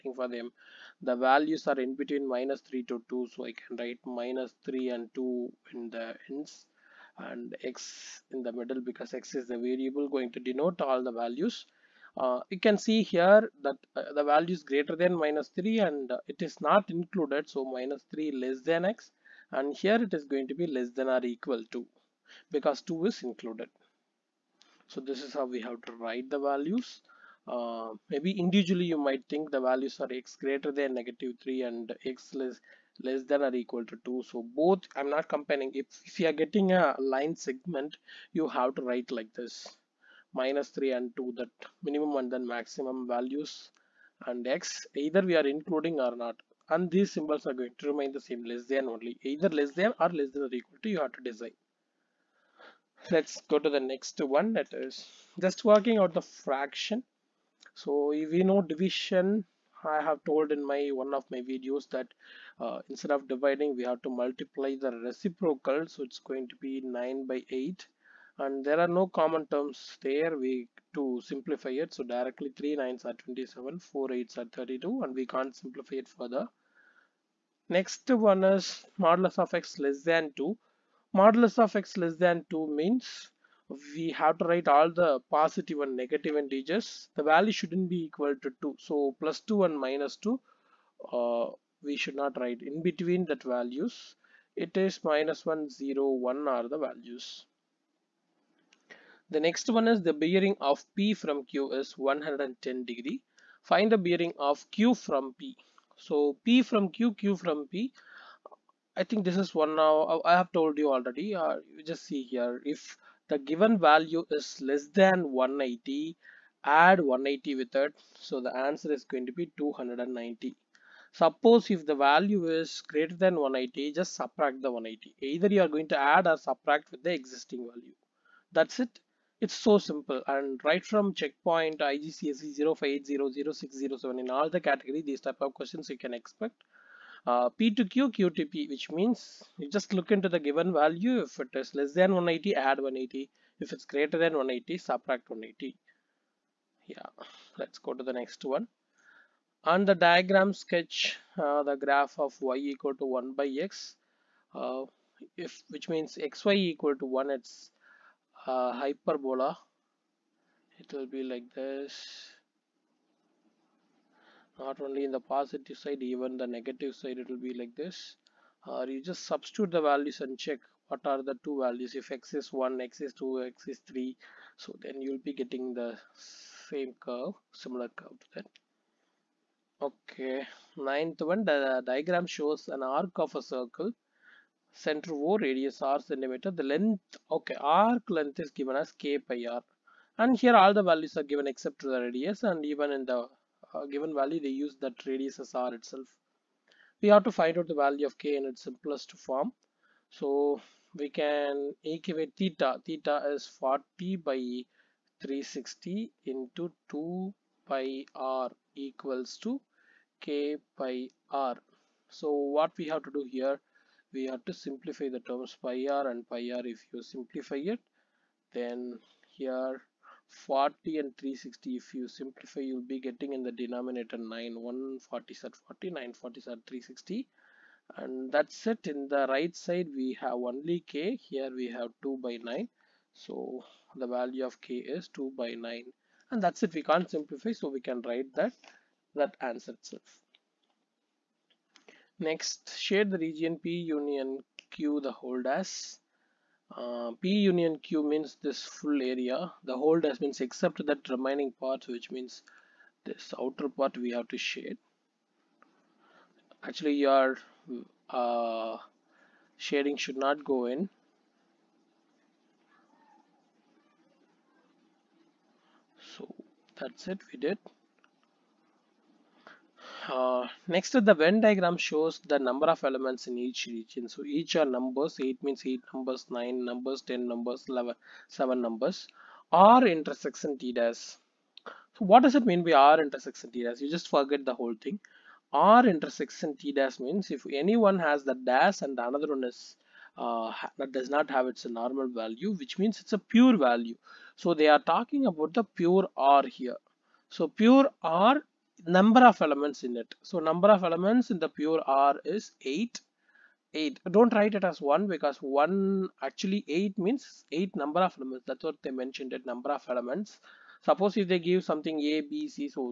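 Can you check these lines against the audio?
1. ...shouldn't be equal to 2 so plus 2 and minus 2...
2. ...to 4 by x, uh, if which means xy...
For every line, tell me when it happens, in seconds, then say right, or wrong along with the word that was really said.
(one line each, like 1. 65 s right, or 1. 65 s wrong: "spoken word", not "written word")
1. 87 s right
2. 152 s wrong: "1", not "4".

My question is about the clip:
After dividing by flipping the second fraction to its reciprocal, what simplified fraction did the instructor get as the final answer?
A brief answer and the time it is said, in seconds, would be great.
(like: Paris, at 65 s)
27/32, at 72 s.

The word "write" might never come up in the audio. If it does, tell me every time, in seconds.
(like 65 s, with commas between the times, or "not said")
3 s, 26 s, 38 s, 84 s, 92 s, 238 s, 304 s.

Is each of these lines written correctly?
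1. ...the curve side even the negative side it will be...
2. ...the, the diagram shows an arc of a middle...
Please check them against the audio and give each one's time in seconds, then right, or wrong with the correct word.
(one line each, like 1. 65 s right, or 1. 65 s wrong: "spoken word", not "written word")
1. 165 s wrong: "positive", not "curve"
2. 181 s wrong: "circle", not "middle".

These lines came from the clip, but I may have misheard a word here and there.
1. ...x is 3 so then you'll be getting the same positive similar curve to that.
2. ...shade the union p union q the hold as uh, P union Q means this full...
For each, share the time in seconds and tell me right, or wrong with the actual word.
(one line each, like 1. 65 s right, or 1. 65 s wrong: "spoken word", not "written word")
1. 173 s wrong: "curve", not "positive"
2. 242 s wrong: "region", not "union".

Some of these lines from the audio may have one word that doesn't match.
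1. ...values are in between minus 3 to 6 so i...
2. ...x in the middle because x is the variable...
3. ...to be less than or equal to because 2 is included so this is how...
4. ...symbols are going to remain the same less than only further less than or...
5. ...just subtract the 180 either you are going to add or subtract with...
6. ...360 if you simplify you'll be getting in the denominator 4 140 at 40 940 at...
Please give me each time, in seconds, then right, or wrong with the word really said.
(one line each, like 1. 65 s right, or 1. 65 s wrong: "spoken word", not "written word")
1. 1 s wrong: "2", not "6"
2. 7 s right
3. 20 s right
4. 47 s wrong: "either", not "further"
5. 123 s right
6. 221 s wrong: "9", not "4".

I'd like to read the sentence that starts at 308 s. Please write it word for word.
That's what they mentioned it number of elements.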